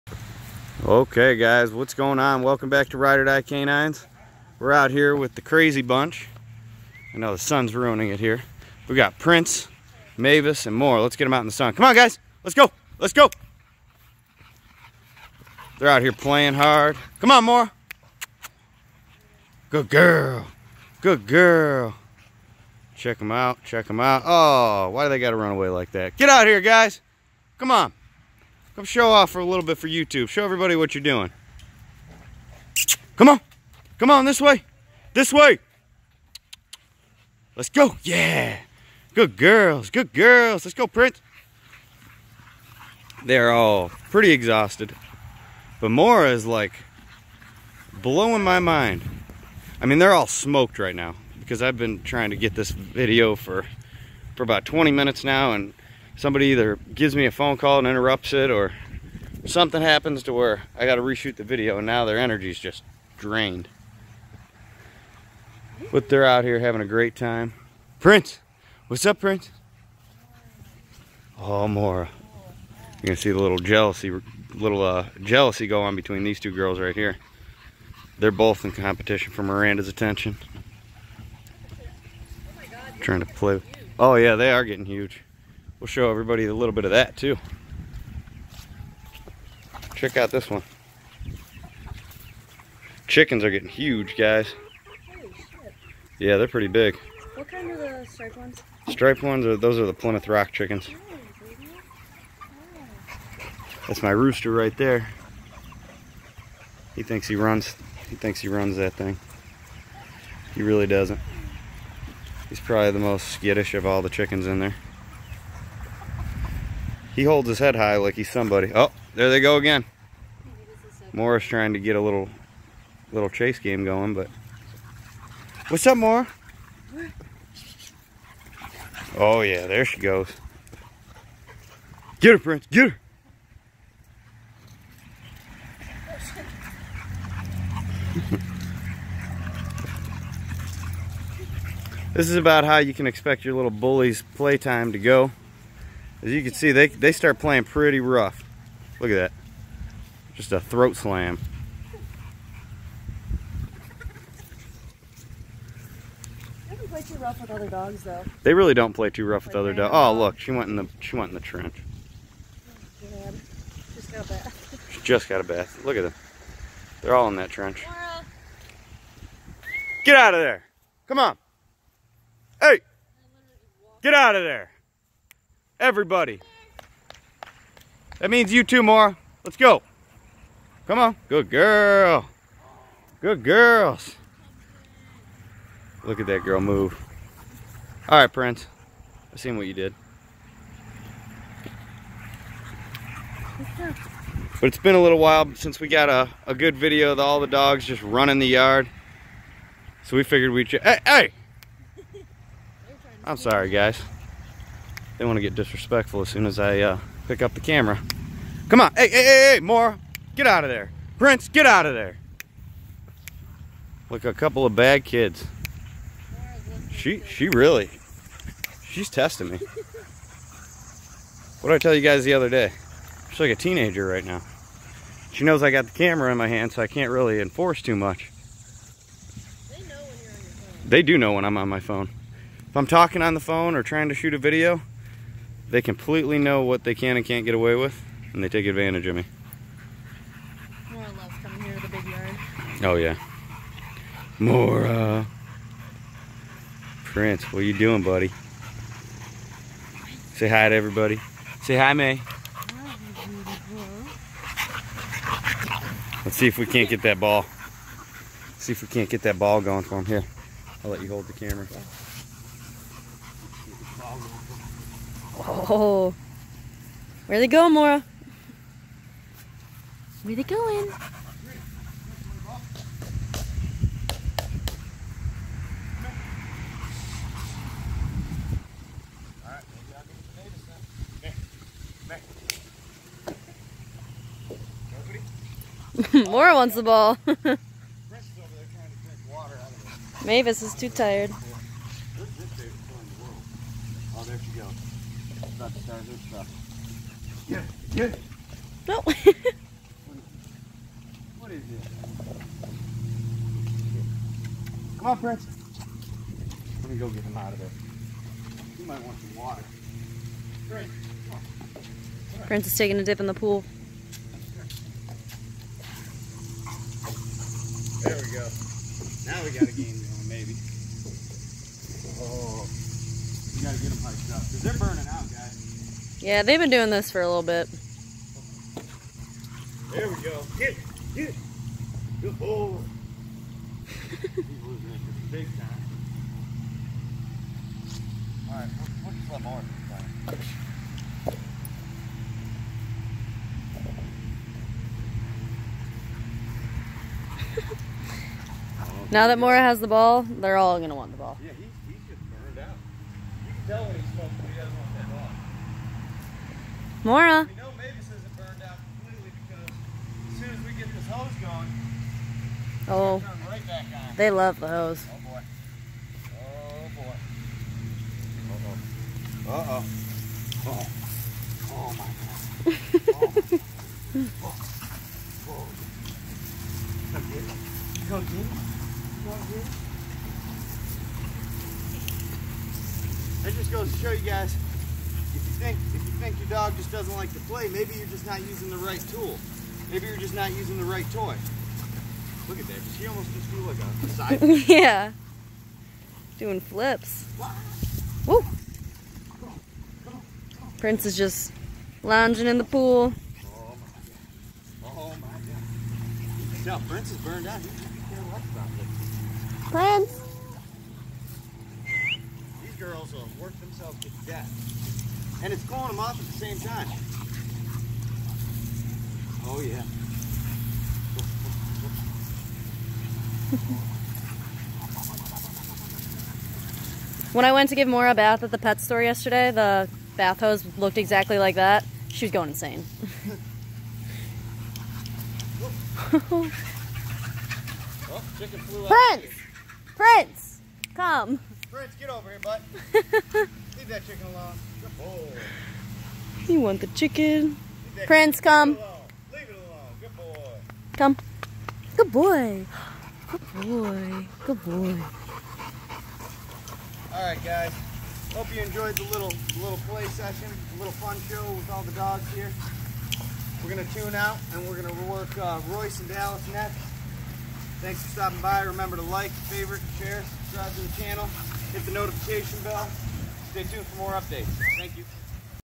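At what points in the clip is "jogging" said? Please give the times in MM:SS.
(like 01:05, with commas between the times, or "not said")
not said.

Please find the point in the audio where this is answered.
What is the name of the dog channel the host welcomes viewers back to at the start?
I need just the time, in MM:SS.
00:02.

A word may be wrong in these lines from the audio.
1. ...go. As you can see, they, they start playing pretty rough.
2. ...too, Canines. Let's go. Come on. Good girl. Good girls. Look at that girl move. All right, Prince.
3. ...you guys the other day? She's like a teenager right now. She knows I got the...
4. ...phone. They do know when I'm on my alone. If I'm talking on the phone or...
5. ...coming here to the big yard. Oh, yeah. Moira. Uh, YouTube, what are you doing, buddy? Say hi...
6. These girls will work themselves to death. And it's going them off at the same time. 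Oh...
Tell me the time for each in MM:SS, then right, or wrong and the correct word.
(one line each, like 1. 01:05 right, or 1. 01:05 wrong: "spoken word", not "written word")
1. 02:24 right
2. 02:58 wrong: "Moira", not "Canines"
3. 03:41 right
4. 03:50 wrong: "phone", not "alone"
5. 04:01 wrong: "Prince", not "YouTube"
6. 06:52 right.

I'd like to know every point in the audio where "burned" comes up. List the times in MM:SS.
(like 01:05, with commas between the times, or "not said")
05:52, 05:58, 06:47.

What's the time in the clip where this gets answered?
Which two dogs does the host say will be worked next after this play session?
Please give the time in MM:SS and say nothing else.
07:45.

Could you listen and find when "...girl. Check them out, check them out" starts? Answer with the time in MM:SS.
00:21.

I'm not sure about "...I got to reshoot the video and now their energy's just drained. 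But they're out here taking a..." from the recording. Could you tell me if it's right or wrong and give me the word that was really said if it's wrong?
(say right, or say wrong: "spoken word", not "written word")
wrong: "having", not "taking".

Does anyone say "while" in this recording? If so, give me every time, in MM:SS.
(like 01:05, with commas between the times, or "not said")
03:15.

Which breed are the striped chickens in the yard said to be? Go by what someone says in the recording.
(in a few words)
Plymouth Rock.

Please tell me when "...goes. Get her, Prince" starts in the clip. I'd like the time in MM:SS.
02:09.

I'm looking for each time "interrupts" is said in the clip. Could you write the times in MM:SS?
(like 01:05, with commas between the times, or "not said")
00:57.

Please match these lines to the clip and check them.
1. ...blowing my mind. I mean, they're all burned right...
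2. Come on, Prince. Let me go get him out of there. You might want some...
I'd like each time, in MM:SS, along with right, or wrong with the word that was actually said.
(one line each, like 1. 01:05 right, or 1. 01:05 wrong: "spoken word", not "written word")
1. 00:48 wrong: "smoked", not "burned"
2. 05:04 right.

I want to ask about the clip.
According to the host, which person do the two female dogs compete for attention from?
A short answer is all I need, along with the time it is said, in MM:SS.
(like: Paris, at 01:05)
Miranda, at 01:19.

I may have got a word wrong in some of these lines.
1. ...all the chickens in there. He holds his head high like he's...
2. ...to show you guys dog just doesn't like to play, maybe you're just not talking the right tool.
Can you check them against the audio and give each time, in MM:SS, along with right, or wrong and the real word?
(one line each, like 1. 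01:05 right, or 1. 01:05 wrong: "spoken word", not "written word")
1. 01:53 right
2. 06:23 wrong: "using", not "talking".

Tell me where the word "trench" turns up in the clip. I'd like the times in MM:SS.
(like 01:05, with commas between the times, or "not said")
02:41, 02:47.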